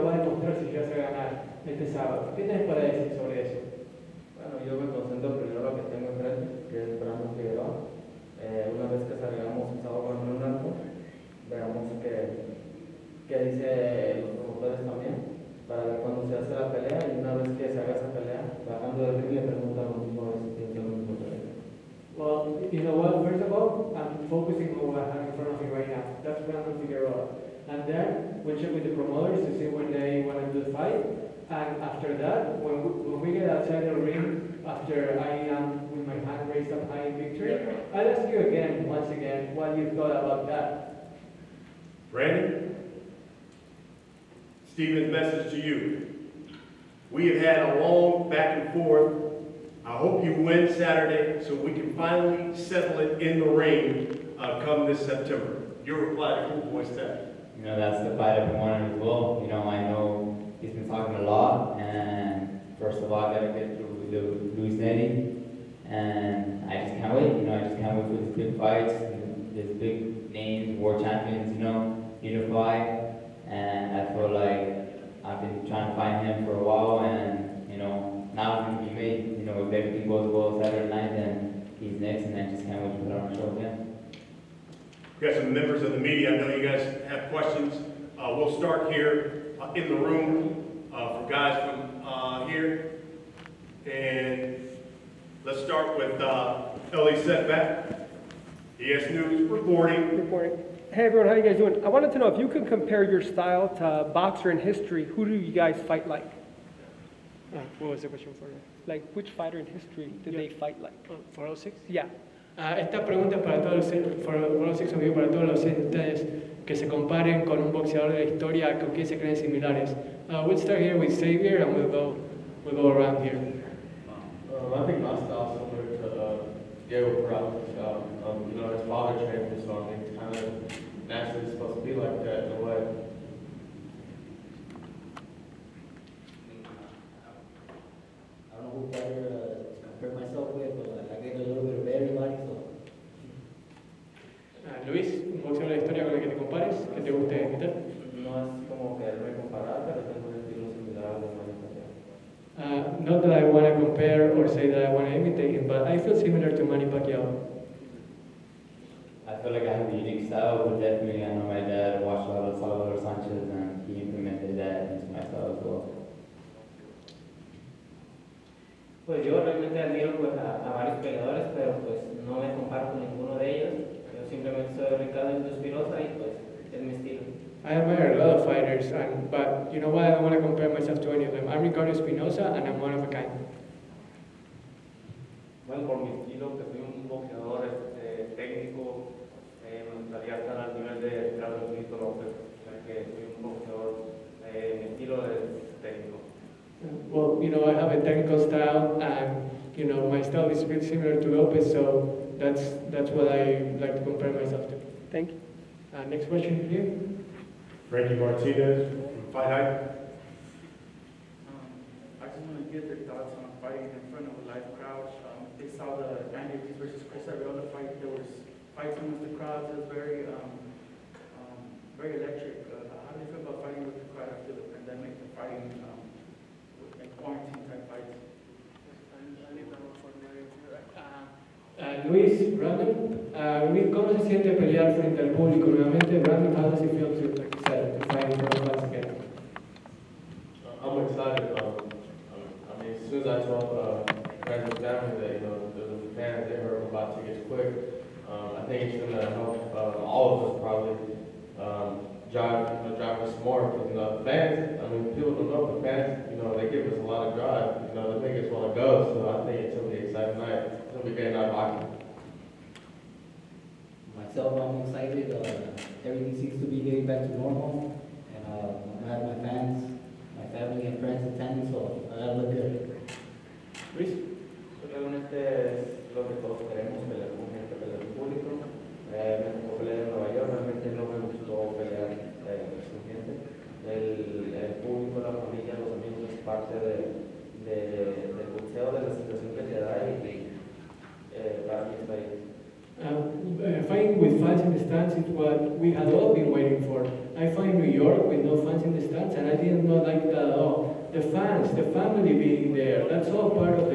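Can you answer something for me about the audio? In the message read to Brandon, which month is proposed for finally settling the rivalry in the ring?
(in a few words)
September.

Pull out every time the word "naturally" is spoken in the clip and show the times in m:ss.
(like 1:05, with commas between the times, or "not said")
2:11.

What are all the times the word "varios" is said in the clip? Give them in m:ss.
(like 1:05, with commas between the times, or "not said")
2:50.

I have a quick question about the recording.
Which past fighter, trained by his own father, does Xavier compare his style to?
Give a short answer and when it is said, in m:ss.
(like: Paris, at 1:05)
Diego Peralta, at 2:06.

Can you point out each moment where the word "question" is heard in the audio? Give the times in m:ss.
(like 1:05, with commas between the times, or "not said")
1:27, 1:48, 3:26.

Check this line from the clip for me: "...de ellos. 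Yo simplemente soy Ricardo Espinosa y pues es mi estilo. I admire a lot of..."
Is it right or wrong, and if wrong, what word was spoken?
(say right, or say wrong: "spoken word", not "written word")
right.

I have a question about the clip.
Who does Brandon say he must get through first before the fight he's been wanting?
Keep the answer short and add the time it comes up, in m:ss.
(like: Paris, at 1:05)
Louis Nery, at 1:04.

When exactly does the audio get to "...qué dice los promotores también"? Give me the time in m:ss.
0:13.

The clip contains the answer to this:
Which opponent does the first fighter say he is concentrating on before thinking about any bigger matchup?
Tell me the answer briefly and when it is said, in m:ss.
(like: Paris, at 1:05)
Brandon Figueroa, at 0:07.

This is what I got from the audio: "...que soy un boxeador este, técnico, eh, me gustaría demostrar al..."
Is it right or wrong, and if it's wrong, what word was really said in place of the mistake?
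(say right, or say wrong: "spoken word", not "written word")
wrong: "estar", not "demostrar".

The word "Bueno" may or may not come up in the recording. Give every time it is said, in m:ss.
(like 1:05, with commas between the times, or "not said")
0:04, 3:05.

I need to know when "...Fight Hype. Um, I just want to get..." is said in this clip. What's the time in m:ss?
3:29.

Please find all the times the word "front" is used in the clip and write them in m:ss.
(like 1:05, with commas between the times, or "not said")
0:25, 3:34.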